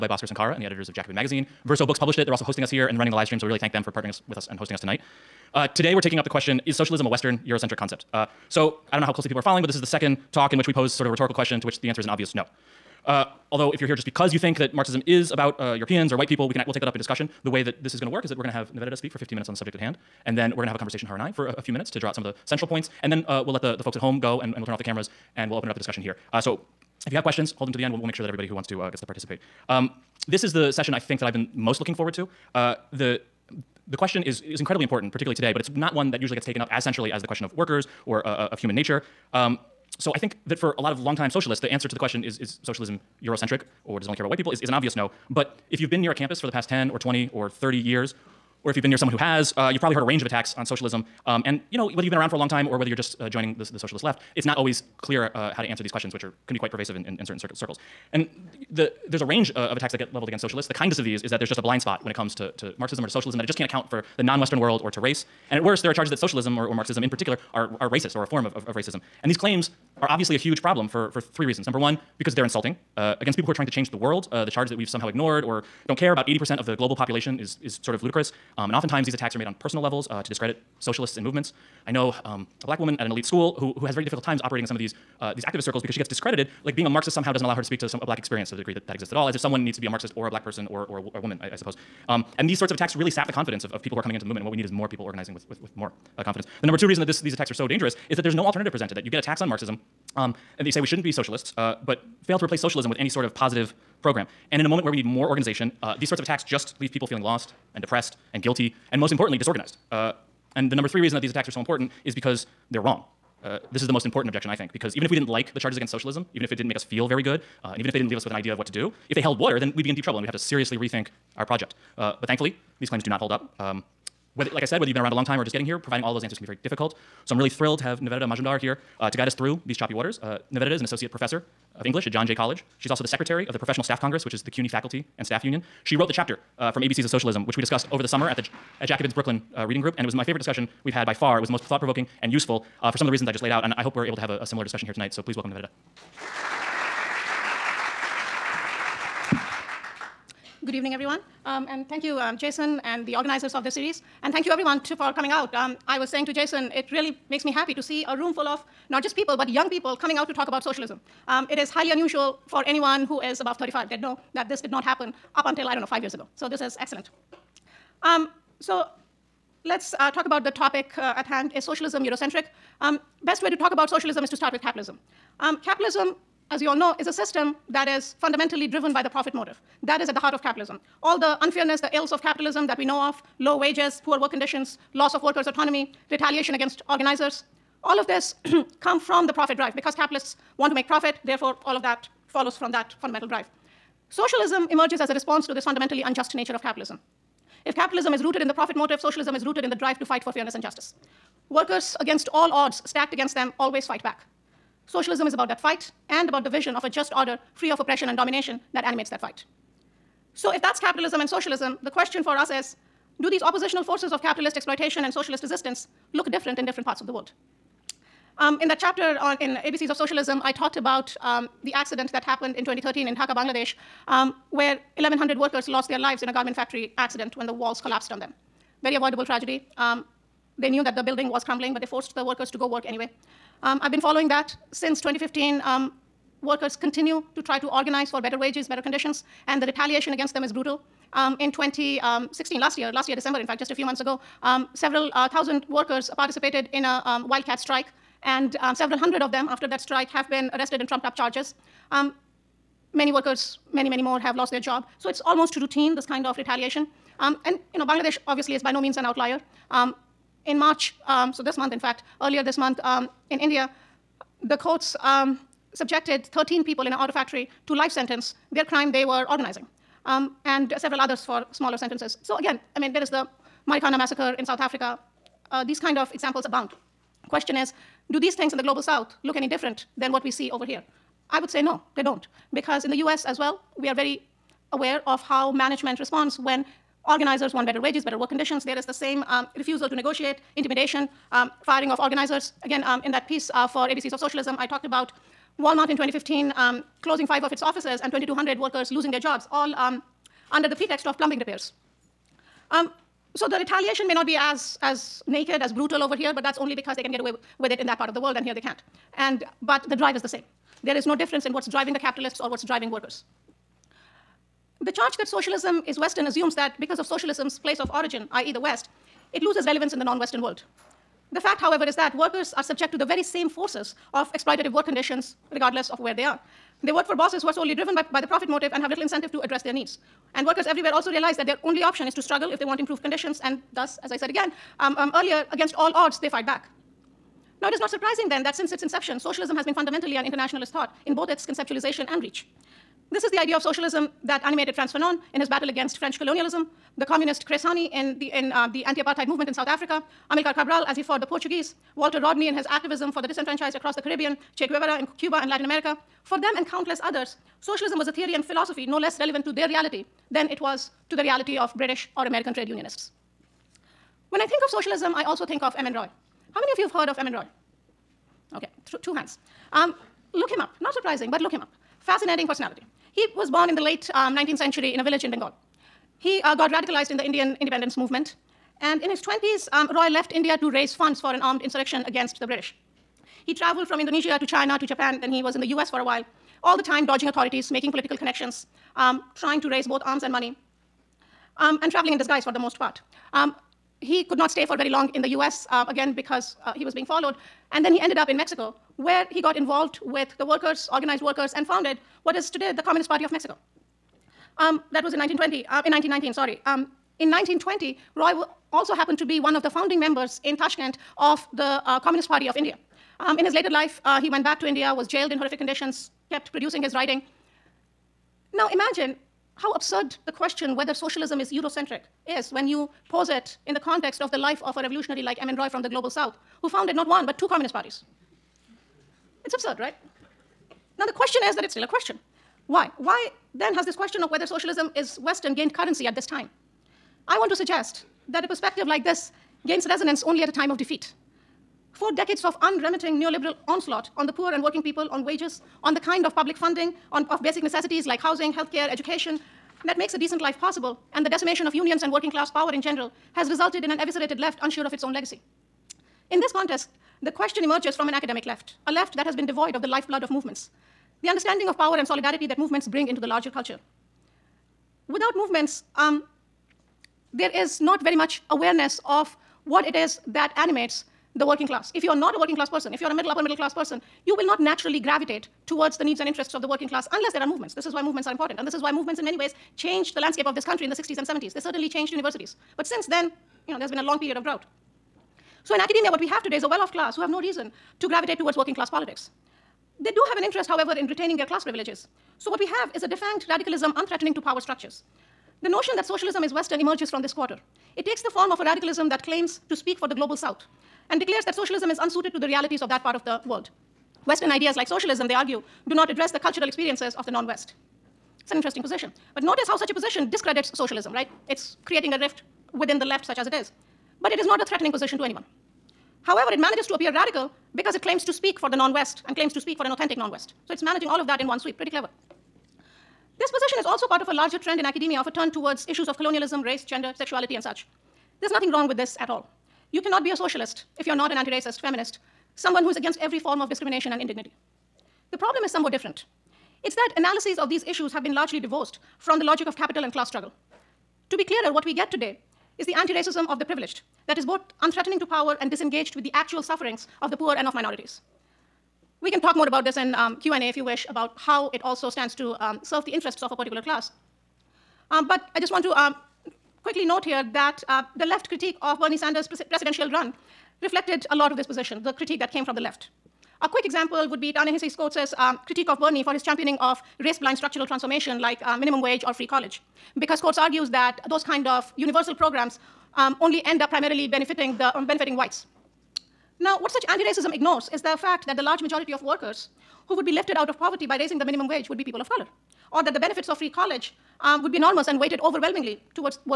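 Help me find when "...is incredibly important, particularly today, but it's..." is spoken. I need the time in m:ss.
0:34.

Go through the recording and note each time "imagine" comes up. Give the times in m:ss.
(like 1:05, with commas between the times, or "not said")
6:58.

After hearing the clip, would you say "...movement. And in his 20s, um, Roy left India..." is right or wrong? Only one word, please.
right.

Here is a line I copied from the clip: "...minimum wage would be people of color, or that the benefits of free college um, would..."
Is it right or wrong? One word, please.
right.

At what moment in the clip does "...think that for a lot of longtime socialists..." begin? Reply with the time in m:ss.
0:40.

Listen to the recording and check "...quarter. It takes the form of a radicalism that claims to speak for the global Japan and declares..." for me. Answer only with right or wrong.
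wrong.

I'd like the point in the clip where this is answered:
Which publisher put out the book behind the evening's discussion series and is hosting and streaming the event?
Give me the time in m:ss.
0:01.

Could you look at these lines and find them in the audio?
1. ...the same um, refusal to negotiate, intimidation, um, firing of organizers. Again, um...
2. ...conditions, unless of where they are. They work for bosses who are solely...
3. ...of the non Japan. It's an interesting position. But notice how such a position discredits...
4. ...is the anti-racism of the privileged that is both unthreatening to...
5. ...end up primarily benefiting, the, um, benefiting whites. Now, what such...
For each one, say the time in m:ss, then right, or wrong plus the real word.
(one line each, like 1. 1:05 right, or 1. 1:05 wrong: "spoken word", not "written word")
1. 4:48 right
2. 5:24 wrong: "regardless", not "unless"
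3. 8:27 wrong: "West", not "Japan"
4. 9:02 right
5. 9:33 right.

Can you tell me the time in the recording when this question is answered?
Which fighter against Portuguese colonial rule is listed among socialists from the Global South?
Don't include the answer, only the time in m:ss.
5:50.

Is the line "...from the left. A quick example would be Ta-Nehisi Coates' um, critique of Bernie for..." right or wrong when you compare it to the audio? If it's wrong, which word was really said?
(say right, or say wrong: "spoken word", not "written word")
right.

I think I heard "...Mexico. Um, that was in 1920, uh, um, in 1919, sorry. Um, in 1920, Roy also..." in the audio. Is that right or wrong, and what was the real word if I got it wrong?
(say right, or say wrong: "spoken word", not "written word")
right.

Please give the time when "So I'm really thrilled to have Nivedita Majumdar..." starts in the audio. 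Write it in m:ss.
2:07.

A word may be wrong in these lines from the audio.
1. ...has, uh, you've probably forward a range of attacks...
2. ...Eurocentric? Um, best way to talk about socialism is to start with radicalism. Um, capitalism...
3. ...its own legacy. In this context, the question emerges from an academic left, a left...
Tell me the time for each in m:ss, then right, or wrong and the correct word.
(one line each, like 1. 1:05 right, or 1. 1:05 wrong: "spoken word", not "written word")
1. 0:49 wrong: "heard", not "forward"
2. 2:52 wrong: "capitalism", not "radicalism"
3. 7:34 right.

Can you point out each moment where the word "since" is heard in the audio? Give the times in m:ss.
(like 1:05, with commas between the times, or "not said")
3:54, 5:38, 8:02.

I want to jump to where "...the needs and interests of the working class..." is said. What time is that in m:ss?
7:55.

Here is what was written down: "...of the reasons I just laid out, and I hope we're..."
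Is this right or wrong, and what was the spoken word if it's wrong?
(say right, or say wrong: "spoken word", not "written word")
right.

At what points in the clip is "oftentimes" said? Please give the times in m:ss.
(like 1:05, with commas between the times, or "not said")
1:18.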